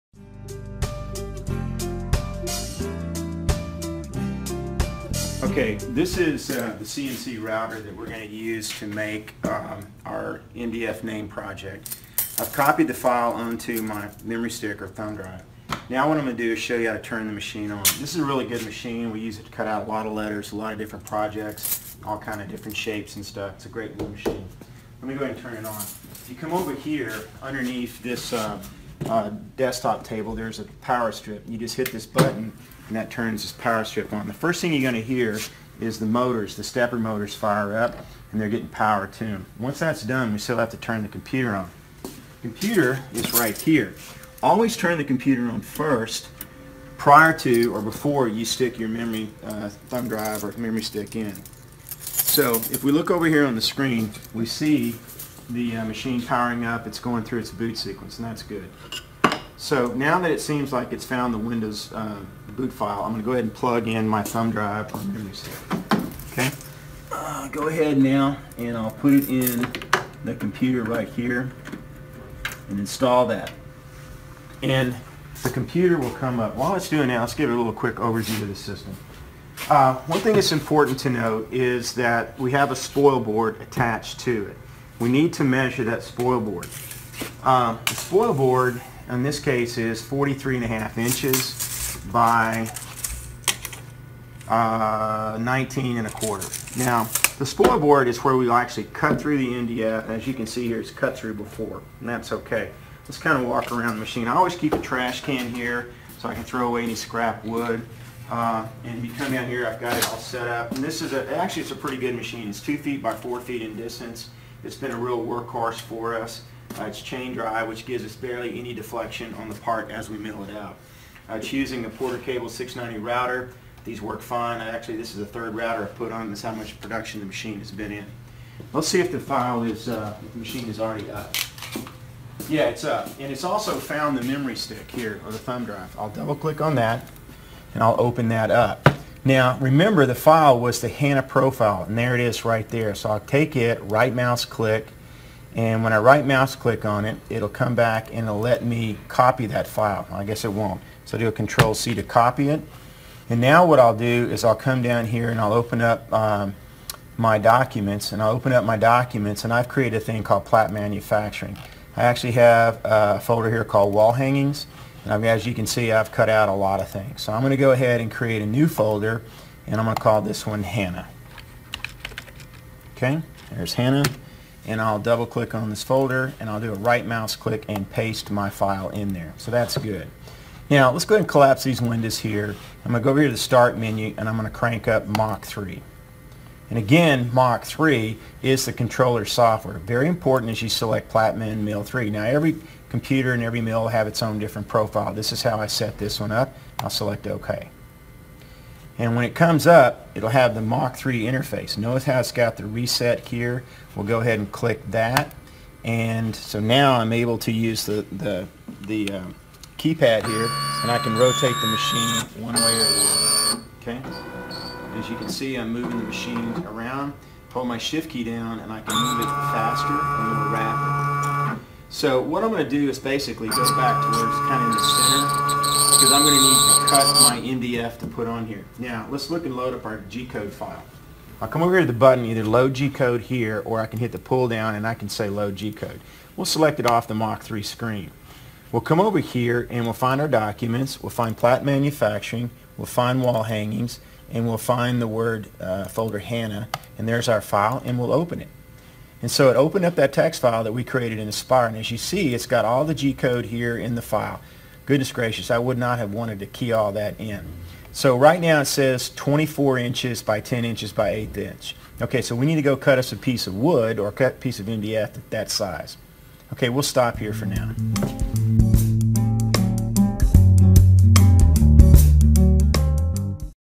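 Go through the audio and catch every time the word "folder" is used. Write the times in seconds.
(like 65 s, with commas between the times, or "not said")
163 s, 168 s, 175 s, 245 s.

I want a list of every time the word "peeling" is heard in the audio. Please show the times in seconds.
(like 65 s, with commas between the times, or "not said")
not said.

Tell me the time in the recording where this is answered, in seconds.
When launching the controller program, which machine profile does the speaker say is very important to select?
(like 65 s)
191 s.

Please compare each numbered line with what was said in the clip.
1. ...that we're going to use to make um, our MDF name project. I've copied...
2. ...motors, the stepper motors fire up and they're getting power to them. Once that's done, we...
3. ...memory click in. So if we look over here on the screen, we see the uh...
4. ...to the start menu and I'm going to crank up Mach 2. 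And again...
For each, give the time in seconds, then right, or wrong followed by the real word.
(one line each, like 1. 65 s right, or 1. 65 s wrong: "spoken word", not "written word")
1. 7 s right
2. 36 s right
3. 50 s wrong: "stick", not "click"
4. 183 s wrong: "3", not "2".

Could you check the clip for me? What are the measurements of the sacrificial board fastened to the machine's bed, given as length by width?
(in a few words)
43.5 by 19.25 inches.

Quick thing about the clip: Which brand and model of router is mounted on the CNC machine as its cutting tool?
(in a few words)
Porter Cable 690.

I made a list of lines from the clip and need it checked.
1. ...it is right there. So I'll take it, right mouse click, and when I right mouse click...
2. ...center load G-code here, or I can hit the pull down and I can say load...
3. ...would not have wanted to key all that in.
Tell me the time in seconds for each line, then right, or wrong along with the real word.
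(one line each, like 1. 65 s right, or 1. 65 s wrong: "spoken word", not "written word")
1. 142 s right
2. 232 s wrong: "either", not "center"
3. 255 s right.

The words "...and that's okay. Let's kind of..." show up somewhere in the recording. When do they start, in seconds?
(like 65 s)
101 s.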